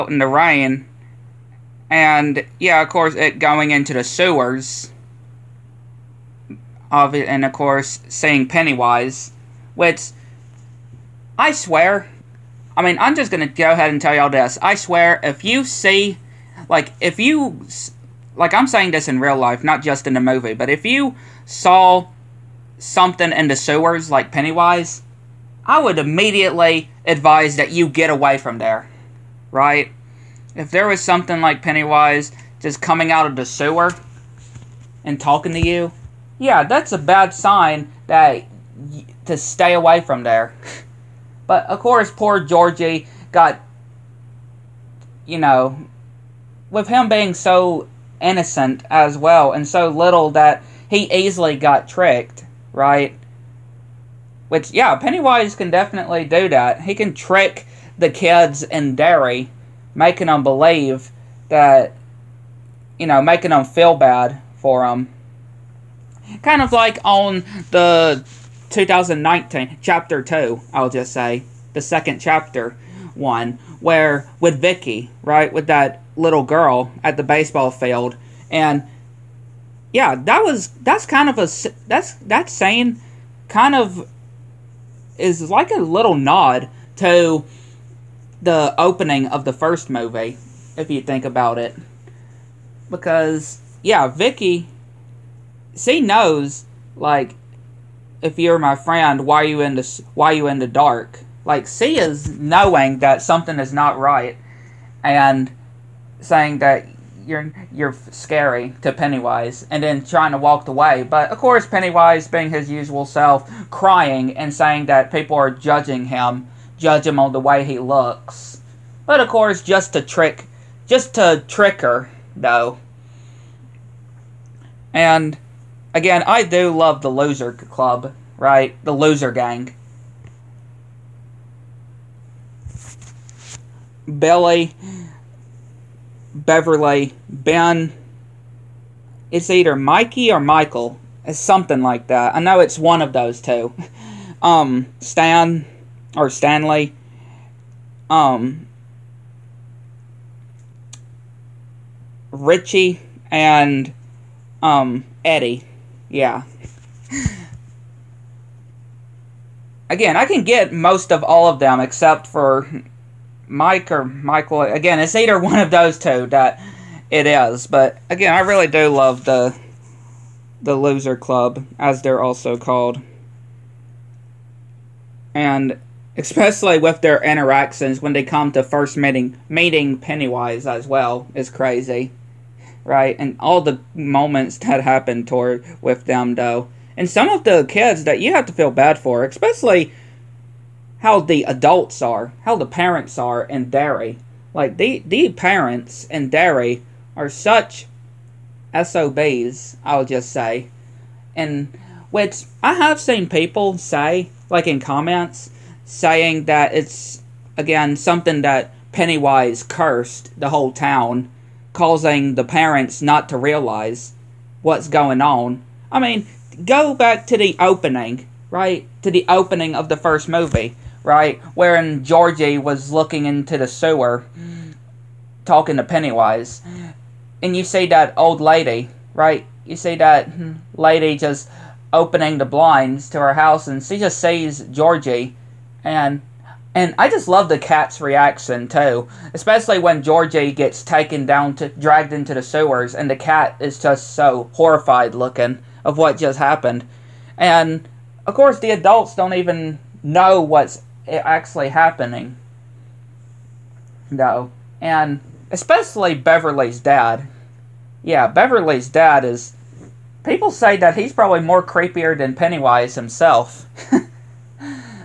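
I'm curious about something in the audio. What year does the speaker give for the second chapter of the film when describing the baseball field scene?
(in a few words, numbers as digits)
2019.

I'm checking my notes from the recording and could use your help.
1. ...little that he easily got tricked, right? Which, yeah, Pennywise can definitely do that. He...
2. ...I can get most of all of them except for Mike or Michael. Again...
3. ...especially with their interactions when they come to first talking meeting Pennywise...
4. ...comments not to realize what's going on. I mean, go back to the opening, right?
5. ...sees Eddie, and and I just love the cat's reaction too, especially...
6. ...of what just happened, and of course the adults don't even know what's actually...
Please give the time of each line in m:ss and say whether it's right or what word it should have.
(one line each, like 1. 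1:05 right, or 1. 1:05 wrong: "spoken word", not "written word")
1. 0:49 right
2. 2:40 right
3. 2:56 wrong: "meeting", not "talking"
4. 3:32 wrong: "parents", not "comments"
5. 3:54 wrong: "Georgie", not "Eddie"
6. 4:05 right.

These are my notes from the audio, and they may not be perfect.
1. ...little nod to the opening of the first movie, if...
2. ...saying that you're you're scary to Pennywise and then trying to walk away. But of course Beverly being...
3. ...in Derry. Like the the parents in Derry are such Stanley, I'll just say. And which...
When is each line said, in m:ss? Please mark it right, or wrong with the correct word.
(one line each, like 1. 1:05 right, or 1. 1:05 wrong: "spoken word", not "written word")
1. 1:25 right
2. 1:46 wrong: "Pennywise", not "Beverly"
3. 3:13 wrong: "SOBs", not "Stanley".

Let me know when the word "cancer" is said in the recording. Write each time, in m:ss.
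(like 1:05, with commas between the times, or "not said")
not said.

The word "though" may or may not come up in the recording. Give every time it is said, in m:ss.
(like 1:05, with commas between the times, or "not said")
2:02, 3:06, 4:14.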